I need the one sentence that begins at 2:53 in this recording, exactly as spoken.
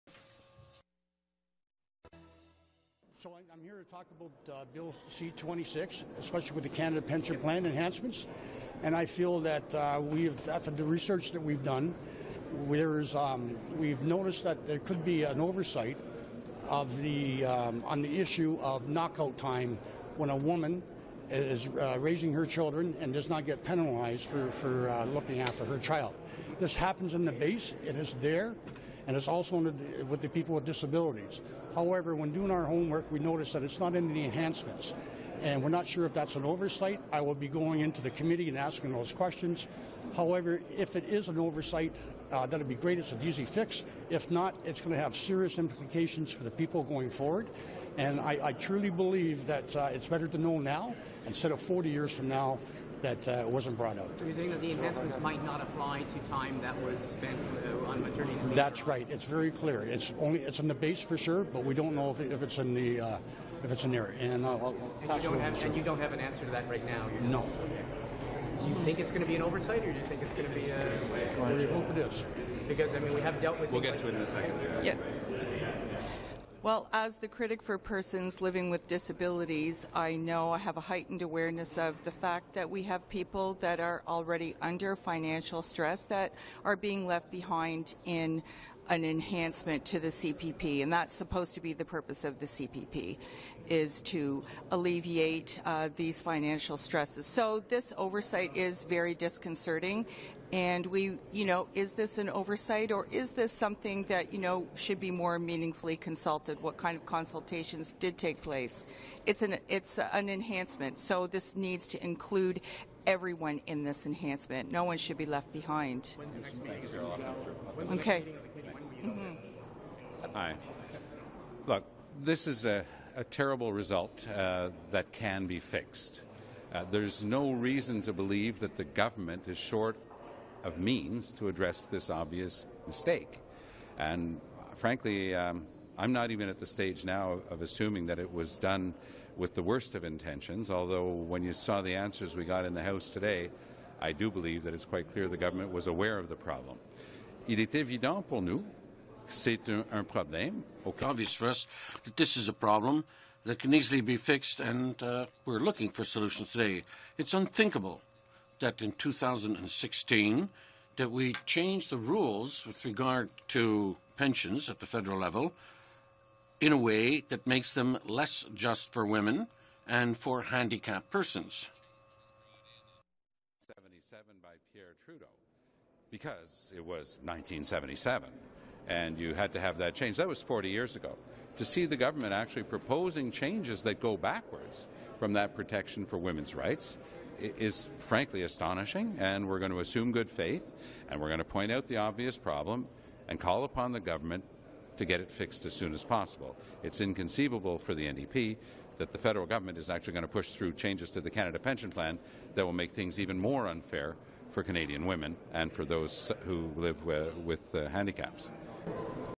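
77 by Pierre Trudeau because it was 1977 and you had to have that change.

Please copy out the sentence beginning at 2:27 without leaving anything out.
Il est évident pour nous c'est un, un, Okay.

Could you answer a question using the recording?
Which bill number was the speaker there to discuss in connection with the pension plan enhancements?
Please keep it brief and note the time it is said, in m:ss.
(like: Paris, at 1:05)
C-26, at 0:04.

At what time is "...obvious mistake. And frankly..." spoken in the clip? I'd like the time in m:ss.
2:12.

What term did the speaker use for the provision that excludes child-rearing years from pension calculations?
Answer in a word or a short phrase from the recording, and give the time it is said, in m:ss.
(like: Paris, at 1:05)
knockout time, at 0:18.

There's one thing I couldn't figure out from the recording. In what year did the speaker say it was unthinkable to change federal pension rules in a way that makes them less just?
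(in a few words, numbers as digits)
2016.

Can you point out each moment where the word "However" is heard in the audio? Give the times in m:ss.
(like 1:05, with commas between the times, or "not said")
0:31, 0:40.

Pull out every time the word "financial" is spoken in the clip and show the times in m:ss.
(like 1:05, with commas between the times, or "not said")
1:24, 1:36.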